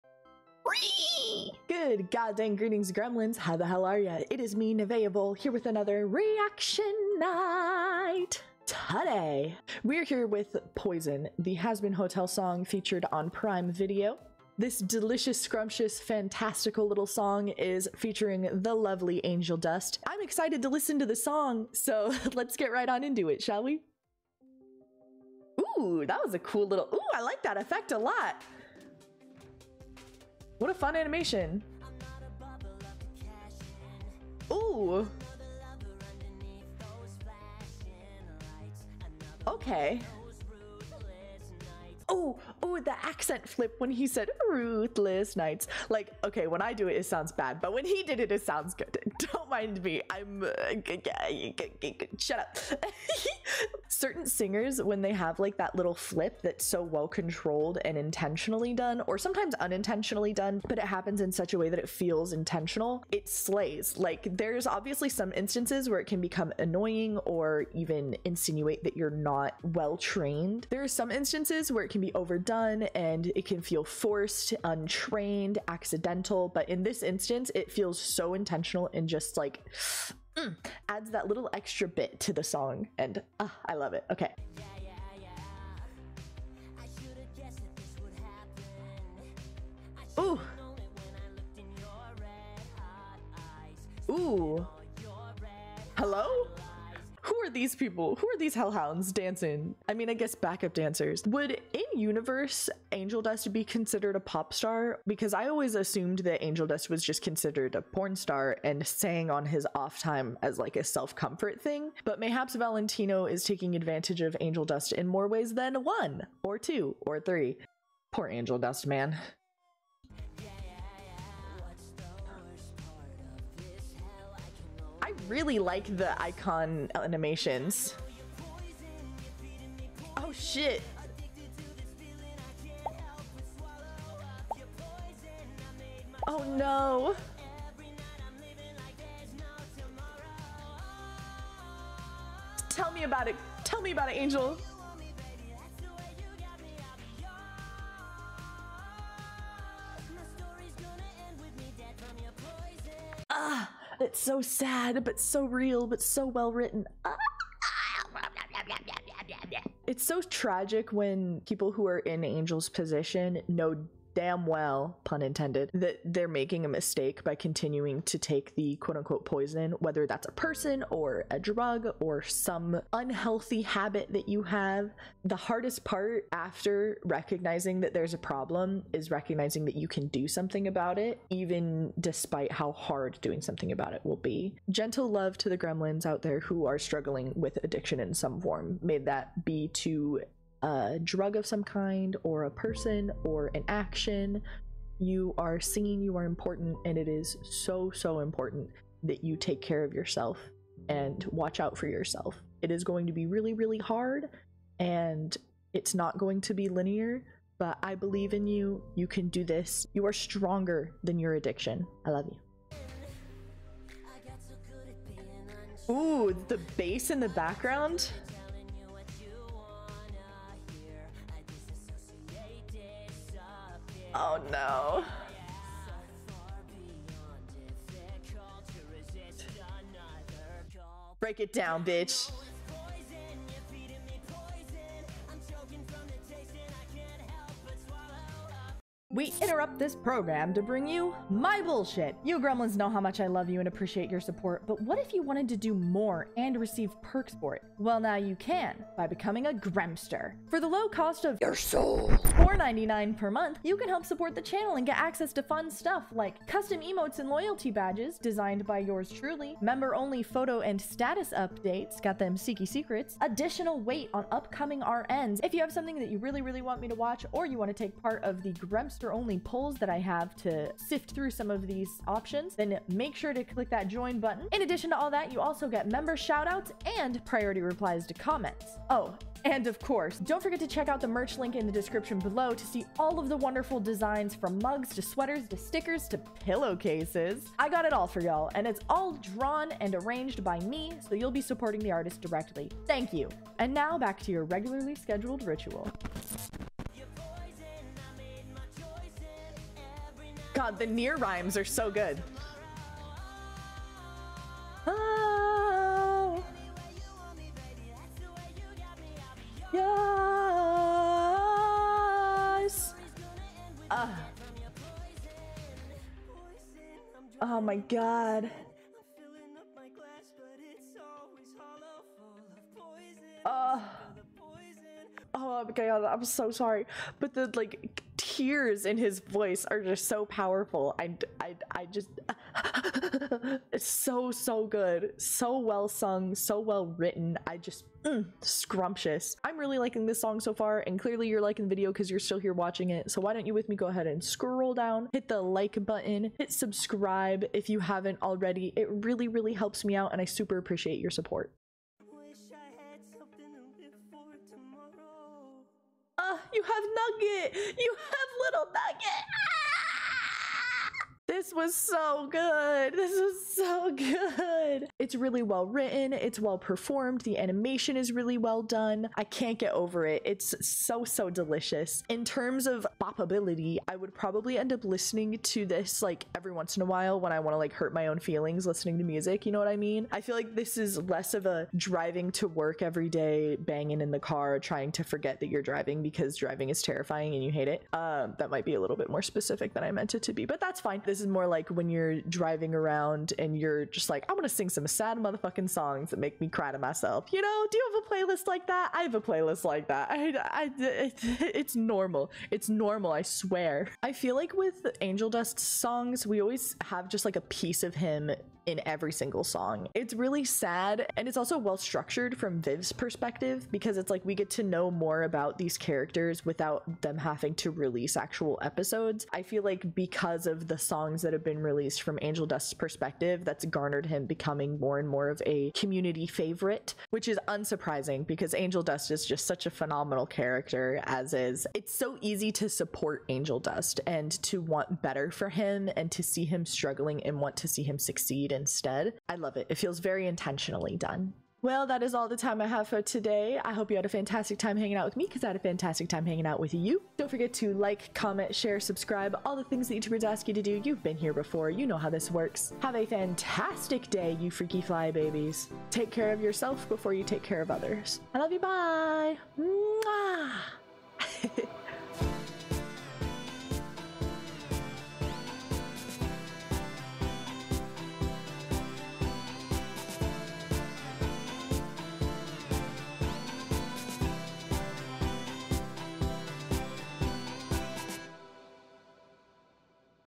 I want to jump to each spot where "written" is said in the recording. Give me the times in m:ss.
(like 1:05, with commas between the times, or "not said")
2:36, 5:36, 6:05.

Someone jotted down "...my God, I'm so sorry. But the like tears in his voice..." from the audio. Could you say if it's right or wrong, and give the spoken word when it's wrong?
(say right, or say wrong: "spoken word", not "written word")
right.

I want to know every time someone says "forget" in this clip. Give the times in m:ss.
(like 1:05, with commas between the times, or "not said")
4:40, 6:25, 7:27.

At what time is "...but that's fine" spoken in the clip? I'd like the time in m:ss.
6:30.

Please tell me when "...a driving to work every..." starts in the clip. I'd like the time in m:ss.
6:21.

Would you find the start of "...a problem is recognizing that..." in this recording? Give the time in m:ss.
2:58.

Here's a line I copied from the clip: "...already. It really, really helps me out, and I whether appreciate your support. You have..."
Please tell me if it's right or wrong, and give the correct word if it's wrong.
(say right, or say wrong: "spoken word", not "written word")
wrong: "super", not "whether".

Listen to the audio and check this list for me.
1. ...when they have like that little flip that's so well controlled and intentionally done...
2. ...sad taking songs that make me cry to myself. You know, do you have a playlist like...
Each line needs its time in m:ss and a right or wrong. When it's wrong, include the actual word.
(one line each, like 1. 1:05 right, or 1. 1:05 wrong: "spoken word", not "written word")
1. 0:54 right
2. 6:34 wrong: "motherfucking", not "taking".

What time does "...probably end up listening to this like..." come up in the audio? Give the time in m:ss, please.
6:14.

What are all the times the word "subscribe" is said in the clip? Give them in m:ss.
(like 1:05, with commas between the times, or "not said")
5:46, 7:28.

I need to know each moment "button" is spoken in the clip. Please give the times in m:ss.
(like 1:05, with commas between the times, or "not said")
4:34, 5:45.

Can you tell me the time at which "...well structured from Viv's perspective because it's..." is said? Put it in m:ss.
6:51.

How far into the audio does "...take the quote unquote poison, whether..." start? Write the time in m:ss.
2:48.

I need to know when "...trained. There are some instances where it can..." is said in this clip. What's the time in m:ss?
1:09.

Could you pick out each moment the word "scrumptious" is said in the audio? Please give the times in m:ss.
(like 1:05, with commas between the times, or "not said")
0:15, 5:38.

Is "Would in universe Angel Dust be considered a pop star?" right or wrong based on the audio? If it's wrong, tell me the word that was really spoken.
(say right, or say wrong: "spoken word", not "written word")
right.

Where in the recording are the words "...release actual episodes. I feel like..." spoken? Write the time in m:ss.
6:57.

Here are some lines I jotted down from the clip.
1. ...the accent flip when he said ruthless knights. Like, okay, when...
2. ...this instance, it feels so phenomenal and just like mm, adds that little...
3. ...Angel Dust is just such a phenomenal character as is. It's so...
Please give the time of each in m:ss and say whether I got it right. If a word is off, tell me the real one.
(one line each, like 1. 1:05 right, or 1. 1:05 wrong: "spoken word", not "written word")
1. 0:42 right
2. 1:16 wrong: "intentional", not "phenomenal"
3. 7:08 right.